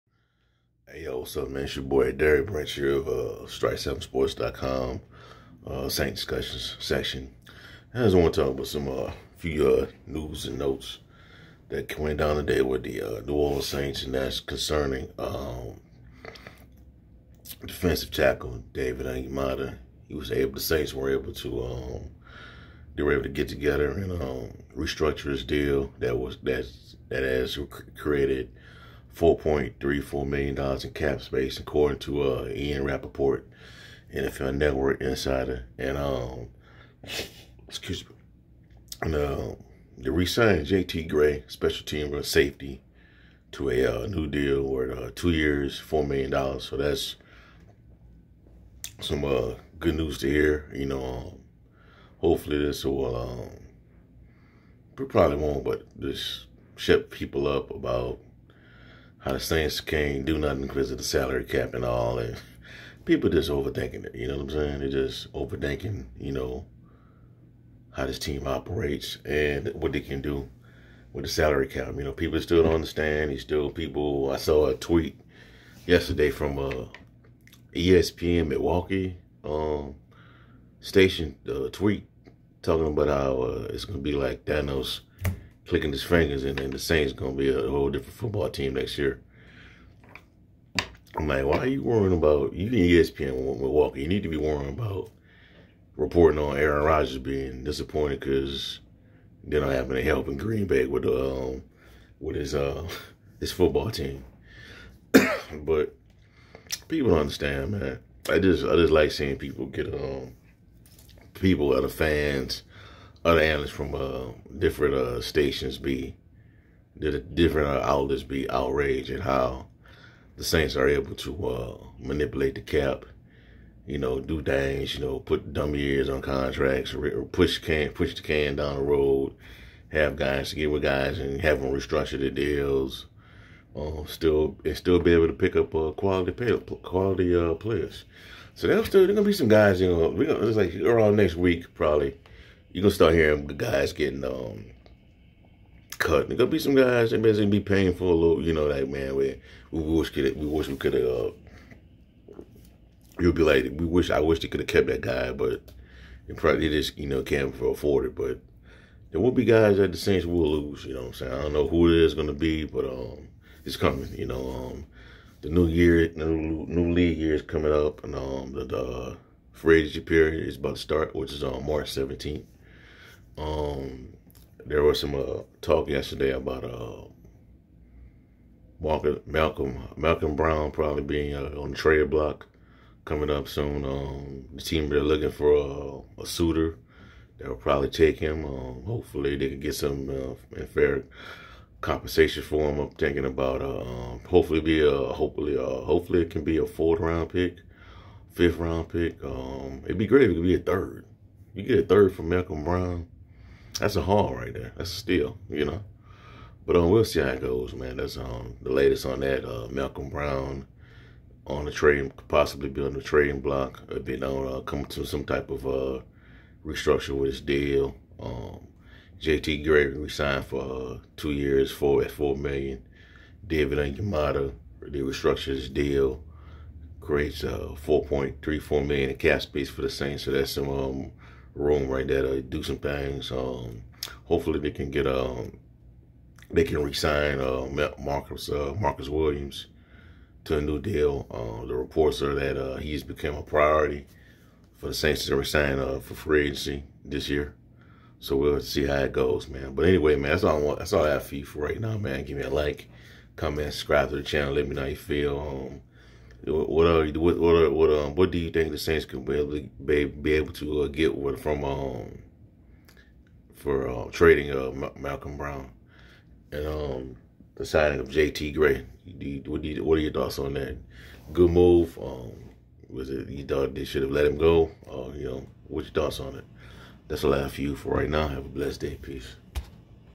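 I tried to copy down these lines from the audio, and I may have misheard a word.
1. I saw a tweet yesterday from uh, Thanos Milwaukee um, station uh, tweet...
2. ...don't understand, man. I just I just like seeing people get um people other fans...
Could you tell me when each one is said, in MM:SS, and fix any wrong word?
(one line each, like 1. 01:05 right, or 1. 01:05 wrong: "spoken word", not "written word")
1. 01:14 wrong: "ESPN", not "Thanos"
2. 01:47 right.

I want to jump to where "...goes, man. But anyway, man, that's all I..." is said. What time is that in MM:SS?
04:09.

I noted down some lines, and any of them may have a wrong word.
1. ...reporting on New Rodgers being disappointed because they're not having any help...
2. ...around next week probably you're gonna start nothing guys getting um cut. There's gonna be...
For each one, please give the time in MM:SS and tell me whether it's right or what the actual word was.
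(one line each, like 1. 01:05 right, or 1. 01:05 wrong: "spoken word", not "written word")
1. 01:35 wrong: "Aaron", not "New"
2. 02:20 wrong: "hearing", not "nothing".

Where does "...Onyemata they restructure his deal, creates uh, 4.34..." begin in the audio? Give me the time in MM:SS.
03:43.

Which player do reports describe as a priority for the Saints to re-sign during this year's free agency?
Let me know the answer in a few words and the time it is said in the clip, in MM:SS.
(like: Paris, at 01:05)
Marcus Williams, at 03:58.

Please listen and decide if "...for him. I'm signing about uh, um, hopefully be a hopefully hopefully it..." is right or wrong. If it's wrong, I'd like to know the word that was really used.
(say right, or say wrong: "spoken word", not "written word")
wrong: "thinking", not "signing".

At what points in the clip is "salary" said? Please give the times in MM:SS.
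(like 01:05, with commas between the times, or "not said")
01:01, 01:11.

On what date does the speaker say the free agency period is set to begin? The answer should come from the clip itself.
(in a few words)
March 17th.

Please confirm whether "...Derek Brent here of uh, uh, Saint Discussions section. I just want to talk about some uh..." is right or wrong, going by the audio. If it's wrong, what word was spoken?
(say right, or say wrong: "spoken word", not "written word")
right.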